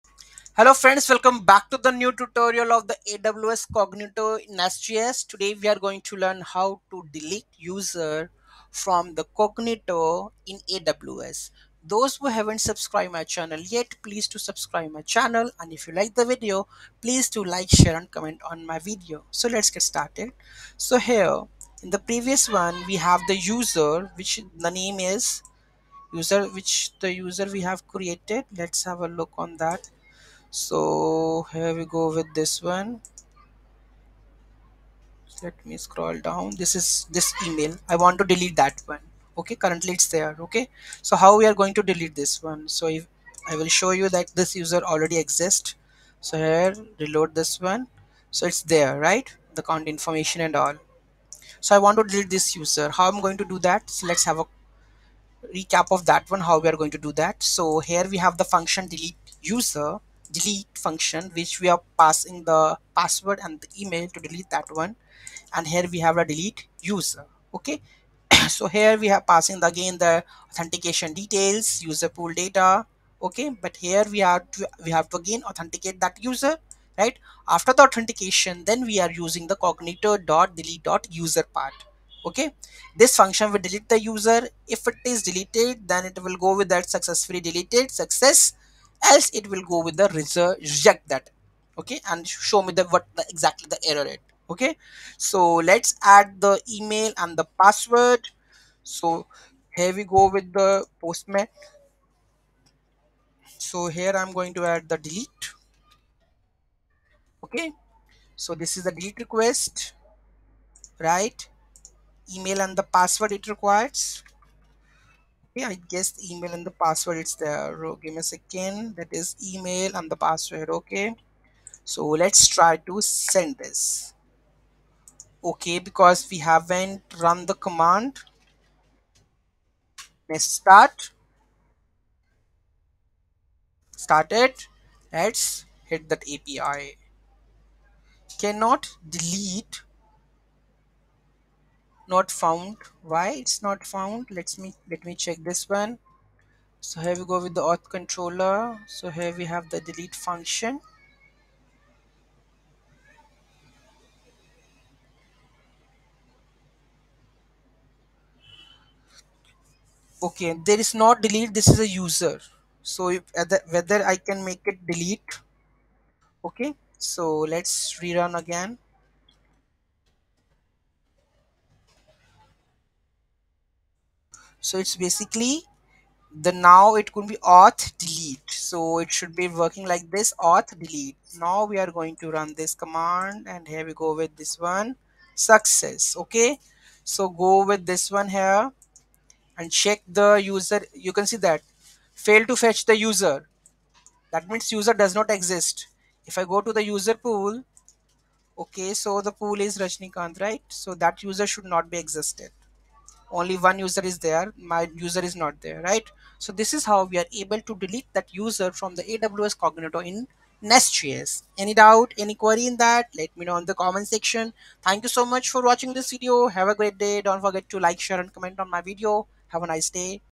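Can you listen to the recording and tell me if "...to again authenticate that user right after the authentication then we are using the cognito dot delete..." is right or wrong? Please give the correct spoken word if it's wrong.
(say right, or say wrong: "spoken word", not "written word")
right.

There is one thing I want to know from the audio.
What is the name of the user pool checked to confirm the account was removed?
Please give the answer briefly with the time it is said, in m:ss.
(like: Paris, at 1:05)
Rajnikant, at 3:19.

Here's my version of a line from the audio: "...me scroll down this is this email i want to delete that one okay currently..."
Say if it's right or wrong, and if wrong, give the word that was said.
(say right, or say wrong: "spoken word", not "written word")
right.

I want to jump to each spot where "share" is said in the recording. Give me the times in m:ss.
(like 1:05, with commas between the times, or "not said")
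0:17, 3:37.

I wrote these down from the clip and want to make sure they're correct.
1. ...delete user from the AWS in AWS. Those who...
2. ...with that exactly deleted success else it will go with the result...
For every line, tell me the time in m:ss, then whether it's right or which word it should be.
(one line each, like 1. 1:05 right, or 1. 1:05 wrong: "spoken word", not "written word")
1. 0:07 wrong: "Cognito", not "AWS"
2. 1:26 wrong: "successfully", not "exactly".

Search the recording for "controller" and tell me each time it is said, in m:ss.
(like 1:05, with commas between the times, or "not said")
2:27.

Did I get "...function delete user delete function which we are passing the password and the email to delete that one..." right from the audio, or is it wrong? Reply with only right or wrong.
right.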